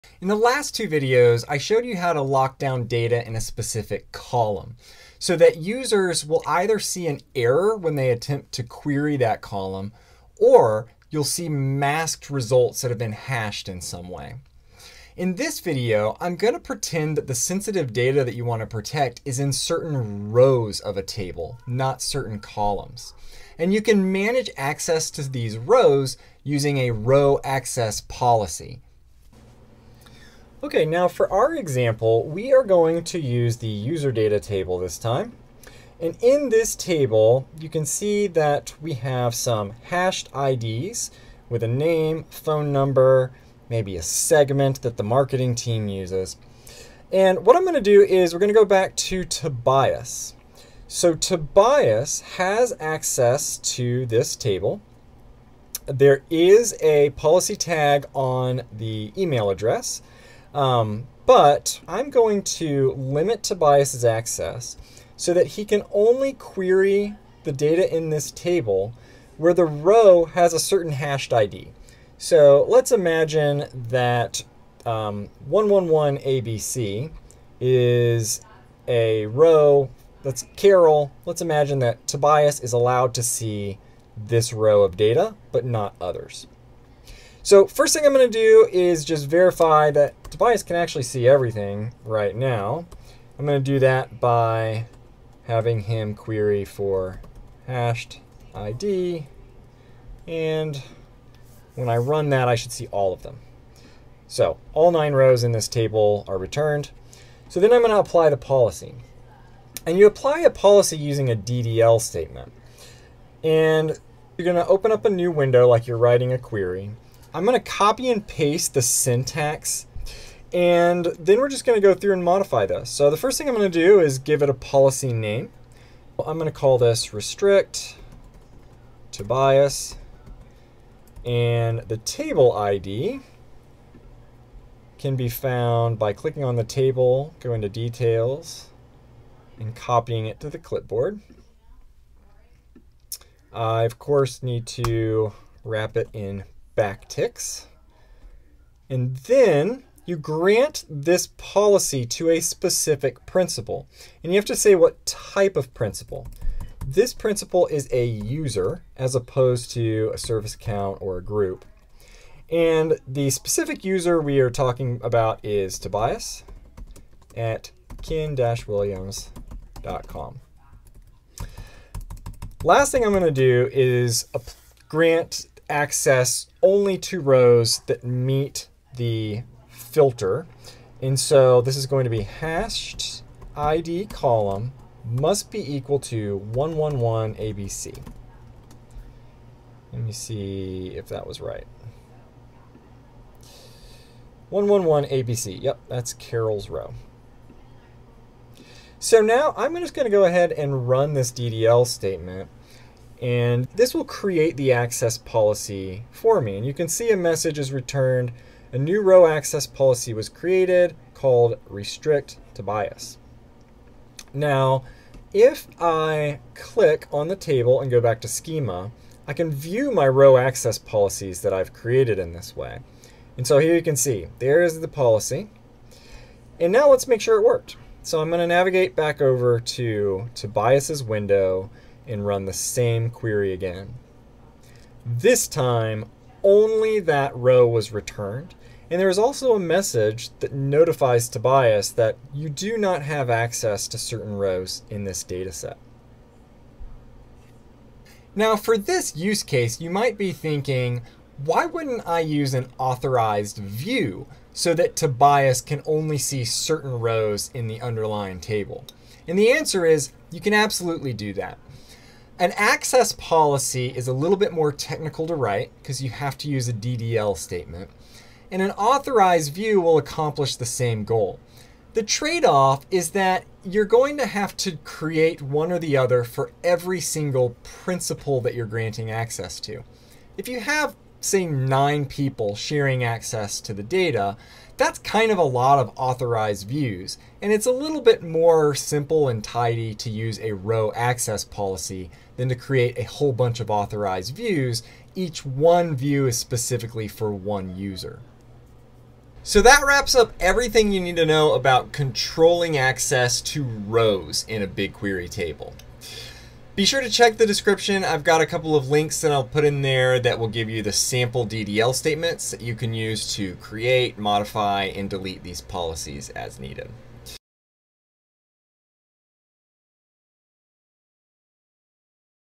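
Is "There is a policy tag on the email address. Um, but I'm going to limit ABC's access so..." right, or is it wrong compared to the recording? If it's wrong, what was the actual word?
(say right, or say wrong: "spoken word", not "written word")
wrong: "Tobias", not "ABC".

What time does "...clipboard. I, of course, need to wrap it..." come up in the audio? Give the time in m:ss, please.
2:20.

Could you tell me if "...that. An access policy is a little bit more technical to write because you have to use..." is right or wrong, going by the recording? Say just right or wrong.
right.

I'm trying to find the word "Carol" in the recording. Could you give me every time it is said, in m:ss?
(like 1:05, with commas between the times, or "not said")
1:20, 3:16.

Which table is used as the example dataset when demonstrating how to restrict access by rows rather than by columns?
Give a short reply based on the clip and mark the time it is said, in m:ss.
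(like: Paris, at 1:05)
user data, at 0:33.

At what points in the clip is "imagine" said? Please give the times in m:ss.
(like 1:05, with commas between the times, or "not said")
1:12, 1:21.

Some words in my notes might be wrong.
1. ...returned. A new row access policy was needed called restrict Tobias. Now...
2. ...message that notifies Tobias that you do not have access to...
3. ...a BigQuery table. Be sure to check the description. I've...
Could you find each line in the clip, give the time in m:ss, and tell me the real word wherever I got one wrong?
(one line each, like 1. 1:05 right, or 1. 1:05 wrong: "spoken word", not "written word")
1. 3:27 wrong: "created", not "needed"
2. 3:59 right
3. 5:04 right.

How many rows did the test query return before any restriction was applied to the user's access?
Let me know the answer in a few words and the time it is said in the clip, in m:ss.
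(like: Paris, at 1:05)
9, at 1:44.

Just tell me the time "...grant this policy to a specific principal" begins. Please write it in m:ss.
2:30.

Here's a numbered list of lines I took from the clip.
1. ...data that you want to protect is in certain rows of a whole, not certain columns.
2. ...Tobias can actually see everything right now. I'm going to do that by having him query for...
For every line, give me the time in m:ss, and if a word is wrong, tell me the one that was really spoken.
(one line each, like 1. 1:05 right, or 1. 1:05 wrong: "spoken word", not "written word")
1. 0:17 wrong: "table", not "whole"
2. 1:30 right.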